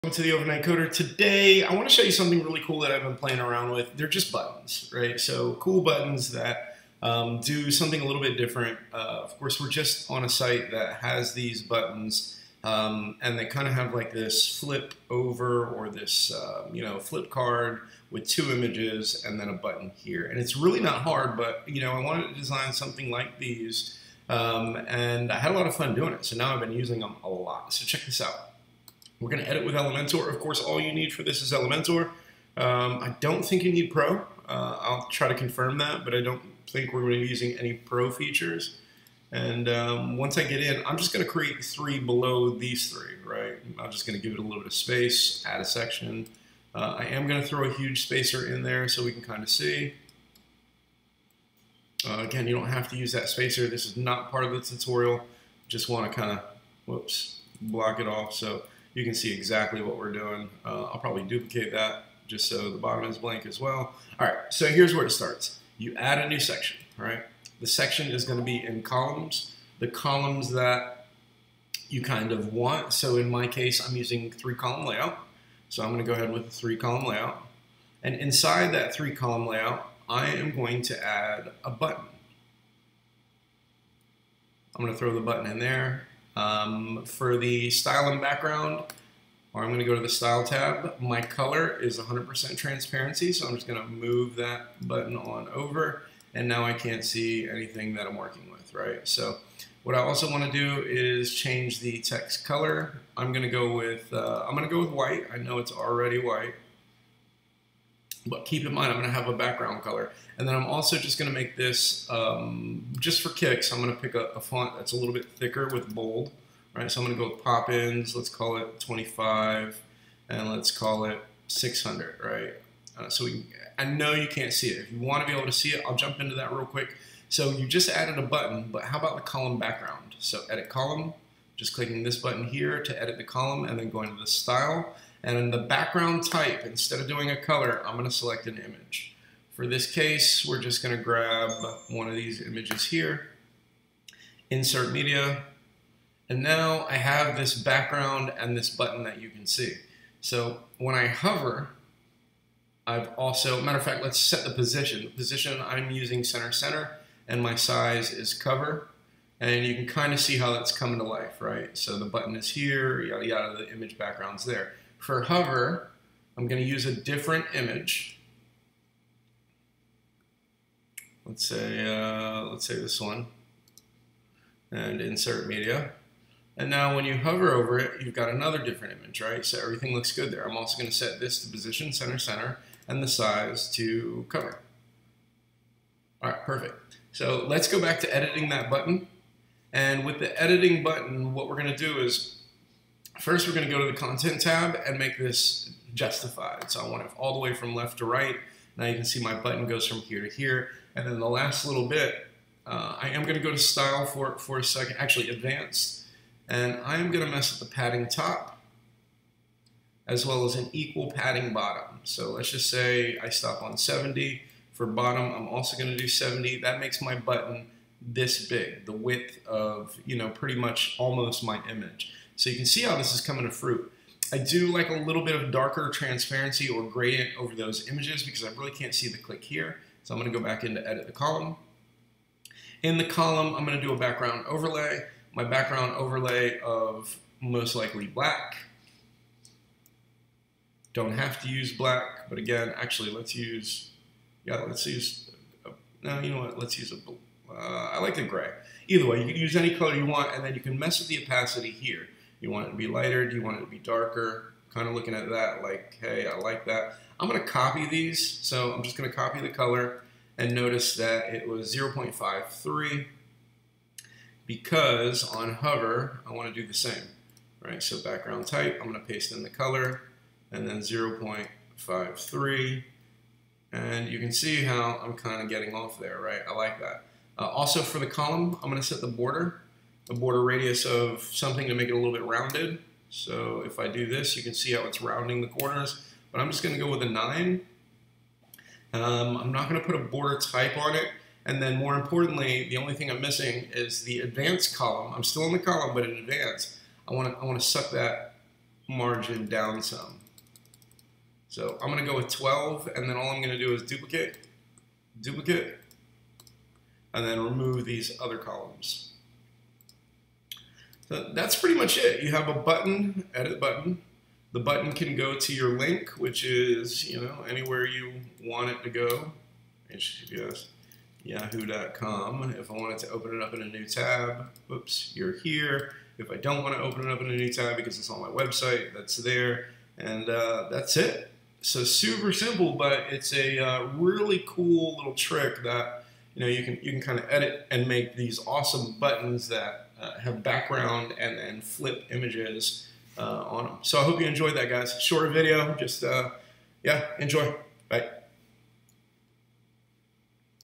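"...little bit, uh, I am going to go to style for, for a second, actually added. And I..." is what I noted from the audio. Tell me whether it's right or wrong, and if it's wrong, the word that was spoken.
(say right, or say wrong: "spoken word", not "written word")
wrong: "advanced", not "added".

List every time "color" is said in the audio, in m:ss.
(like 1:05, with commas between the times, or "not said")
1:31, 1:42, 1:49, 2:17, 4:09, 4:19, 4:29.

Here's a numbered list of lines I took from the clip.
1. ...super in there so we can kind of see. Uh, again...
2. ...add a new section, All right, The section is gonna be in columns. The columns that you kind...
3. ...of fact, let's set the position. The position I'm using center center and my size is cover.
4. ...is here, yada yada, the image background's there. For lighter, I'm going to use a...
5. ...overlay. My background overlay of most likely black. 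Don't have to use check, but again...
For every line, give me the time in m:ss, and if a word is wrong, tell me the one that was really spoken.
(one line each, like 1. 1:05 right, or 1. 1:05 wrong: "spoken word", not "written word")
1. 0:48 wrong: "spacer", not "super"
2. 1:05 right
3. 2:33 right
4. 2:42 wrong: "hover", not "lighter"
5. 3:54 wrong: "black", not "check".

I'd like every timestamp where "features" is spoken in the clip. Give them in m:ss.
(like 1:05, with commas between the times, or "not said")
0:38.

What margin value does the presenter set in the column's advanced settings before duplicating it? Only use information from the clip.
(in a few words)
12.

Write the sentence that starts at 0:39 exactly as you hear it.
And um, once I get in, I'm just going to create three below these three, right?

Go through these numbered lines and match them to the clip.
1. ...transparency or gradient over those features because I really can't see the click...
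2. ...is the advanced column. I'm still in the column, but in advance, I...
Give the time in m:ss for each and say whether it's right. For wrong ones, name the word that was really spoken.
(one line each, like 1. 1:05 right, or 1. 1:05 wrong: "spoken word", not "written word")
1. 3:45 wrong: "images", not "features"
2. 4:53 right.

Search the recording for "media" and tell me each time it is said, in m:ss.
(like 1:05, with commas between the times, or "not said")
2:24, 2:55.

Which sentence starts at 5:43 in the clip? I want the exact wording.
So I hope you enjoyed that, guys.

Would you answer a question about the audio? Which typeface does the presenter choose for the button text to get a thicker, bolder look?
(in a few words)
Poppins.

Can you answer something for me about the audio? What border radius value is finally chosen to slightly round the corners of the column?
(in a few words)
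9.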